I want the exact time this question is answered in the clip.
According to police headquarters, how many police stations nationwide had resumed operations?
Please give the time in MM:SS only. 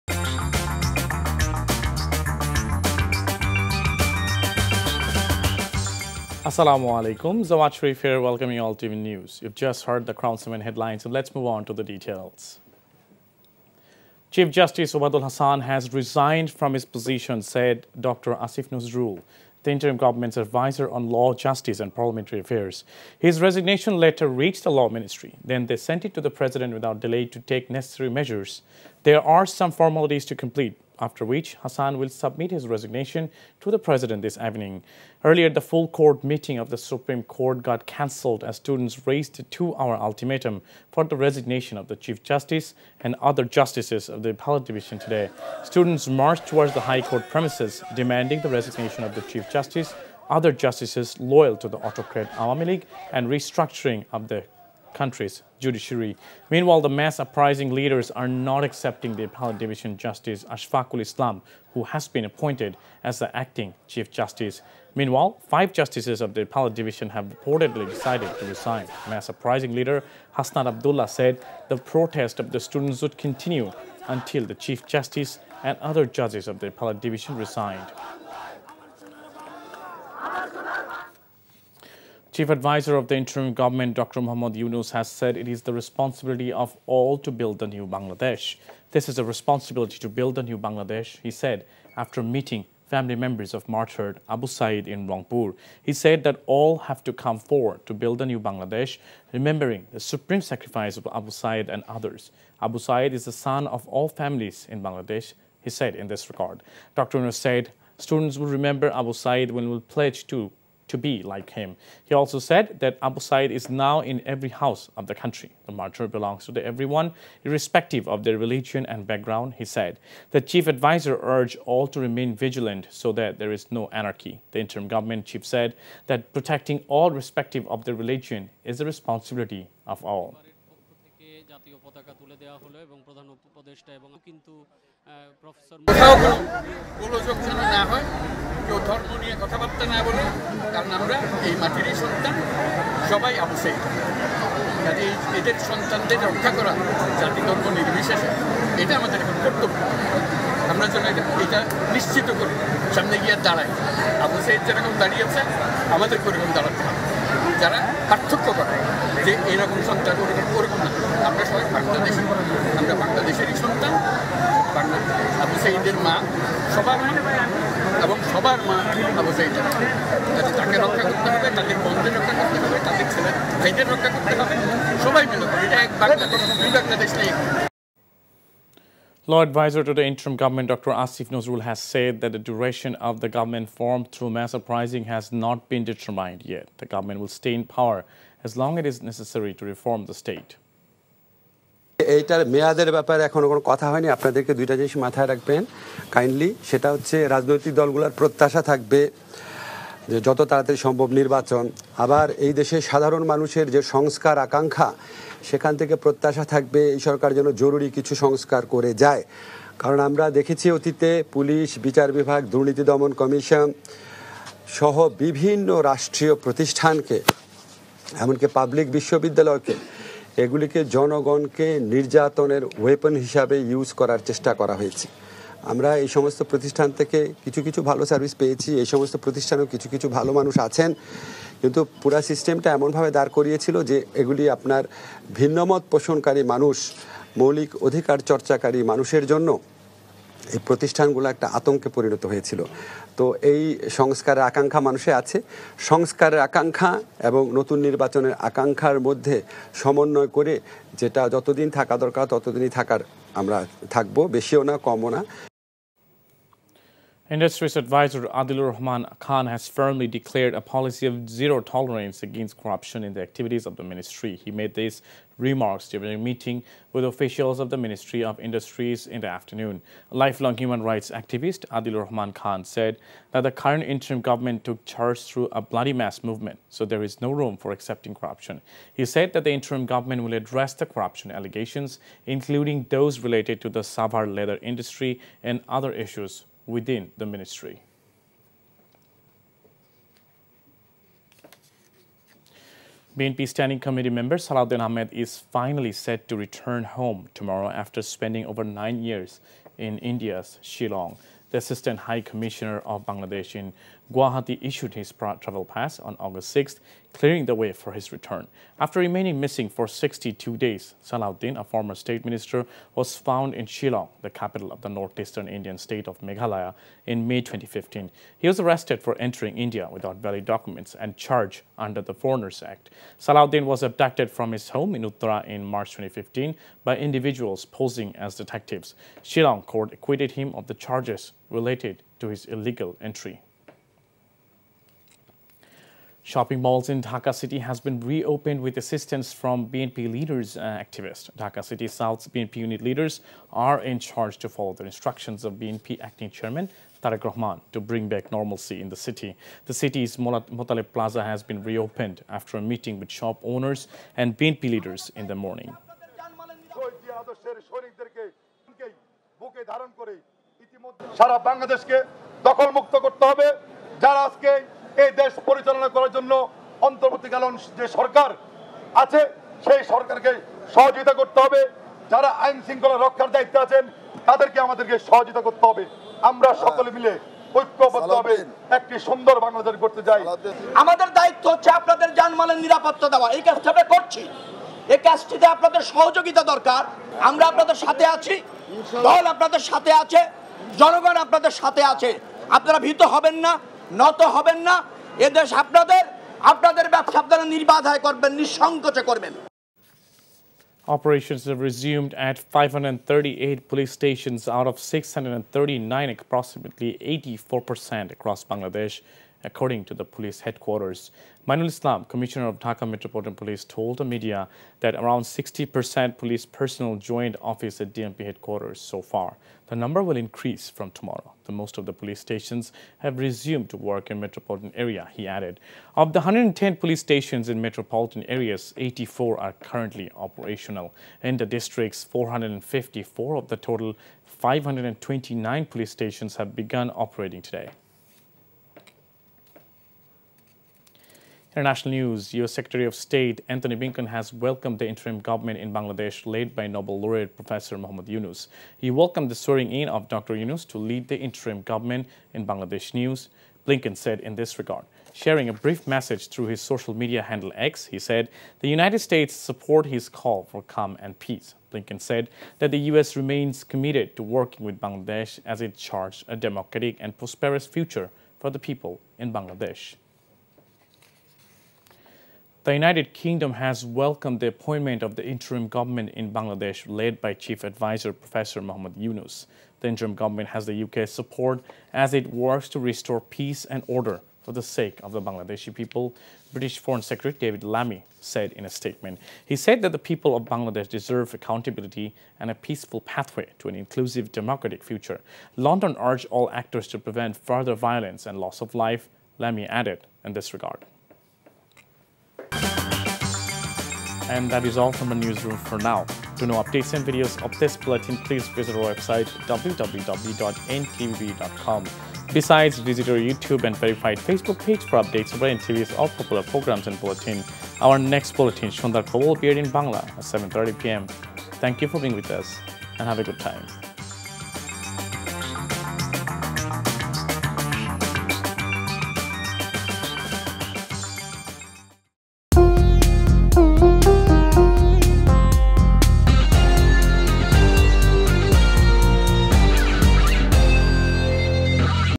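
06:42.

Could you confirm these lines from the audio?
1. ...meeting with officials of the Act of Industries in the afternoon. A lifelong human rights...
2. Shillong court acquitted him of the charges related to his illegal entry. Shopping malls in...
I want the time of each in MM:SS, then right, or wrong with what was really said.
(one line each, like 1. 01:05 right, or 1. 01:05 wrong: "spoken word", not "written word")
1. 04:26 wrong: "Ministry", not "Act"
2. 05:29 right.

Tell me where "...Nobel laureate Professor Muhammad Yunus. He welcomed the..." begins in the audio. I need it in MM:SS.
07:26.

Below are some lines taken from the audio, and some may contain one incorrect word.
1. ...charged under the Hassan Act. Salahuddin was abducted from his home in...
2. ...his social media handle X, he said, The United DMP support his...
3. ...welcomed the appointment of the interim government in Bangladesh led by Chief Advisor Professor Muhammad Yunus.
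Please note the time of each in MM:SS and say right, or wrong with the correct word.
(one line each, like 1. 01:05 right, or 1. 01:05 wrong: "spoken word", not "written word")
1. 05:21 wrong: "Foreigners", not "Hassan"
2. 07:36 wrong: "States", not "DMP"
3. 07:53 right.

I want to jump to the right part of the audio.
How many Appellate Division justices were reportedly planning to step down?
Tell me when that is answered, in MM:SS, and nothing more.
01:05.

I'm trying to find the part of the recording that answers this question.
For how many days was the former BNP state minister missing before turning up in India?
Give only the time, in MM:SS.
05:09.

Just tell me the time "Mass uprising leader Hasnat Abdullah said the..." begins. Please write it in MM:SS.
01:09.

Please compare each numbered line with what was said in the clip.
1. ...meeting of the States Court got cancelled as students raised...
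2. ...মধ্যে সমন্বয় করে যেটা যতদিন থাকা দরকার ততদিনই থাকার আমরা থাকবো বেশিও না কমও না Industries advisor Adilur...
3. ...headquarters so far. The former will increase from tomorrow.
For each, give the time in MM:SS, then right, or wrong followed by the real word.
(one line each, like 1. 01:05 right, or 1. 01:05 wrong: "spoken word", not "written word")
1. 00:36 wrong: "Supreme", not "States"
2. 04:09 right
3. 06:58 wrong: "number", not "former".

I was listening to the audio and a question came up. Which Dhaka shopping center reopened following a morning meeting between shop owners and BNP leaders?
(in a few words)
Motaleb Plaza.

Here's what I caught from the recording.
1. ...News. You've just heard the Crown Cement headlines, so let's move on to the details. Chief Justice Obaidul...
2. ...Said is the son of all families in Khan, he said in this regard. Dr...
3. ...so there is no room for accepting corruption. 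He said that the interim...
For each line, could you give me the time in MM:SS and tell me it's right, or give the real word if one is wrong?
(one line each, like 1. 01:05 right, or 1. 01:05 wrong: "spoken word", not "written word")
1. 00:09 right
2. 01:42 wrong: "Bangladesh", not "Khan"
3. 04:36 right.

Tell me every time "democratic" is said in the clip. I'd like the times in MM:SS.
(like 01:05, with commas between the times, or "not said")
07:46, 08:14.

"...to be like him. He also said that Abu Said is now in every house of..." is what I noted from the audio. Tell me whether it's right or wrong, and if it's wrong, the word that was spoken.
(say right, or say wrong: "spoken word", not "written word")
right.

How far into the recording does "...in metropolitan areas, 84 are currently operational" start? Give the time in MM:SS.
07:07.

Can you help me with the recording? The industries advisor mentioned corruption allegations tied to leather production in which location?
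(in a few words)
Savar.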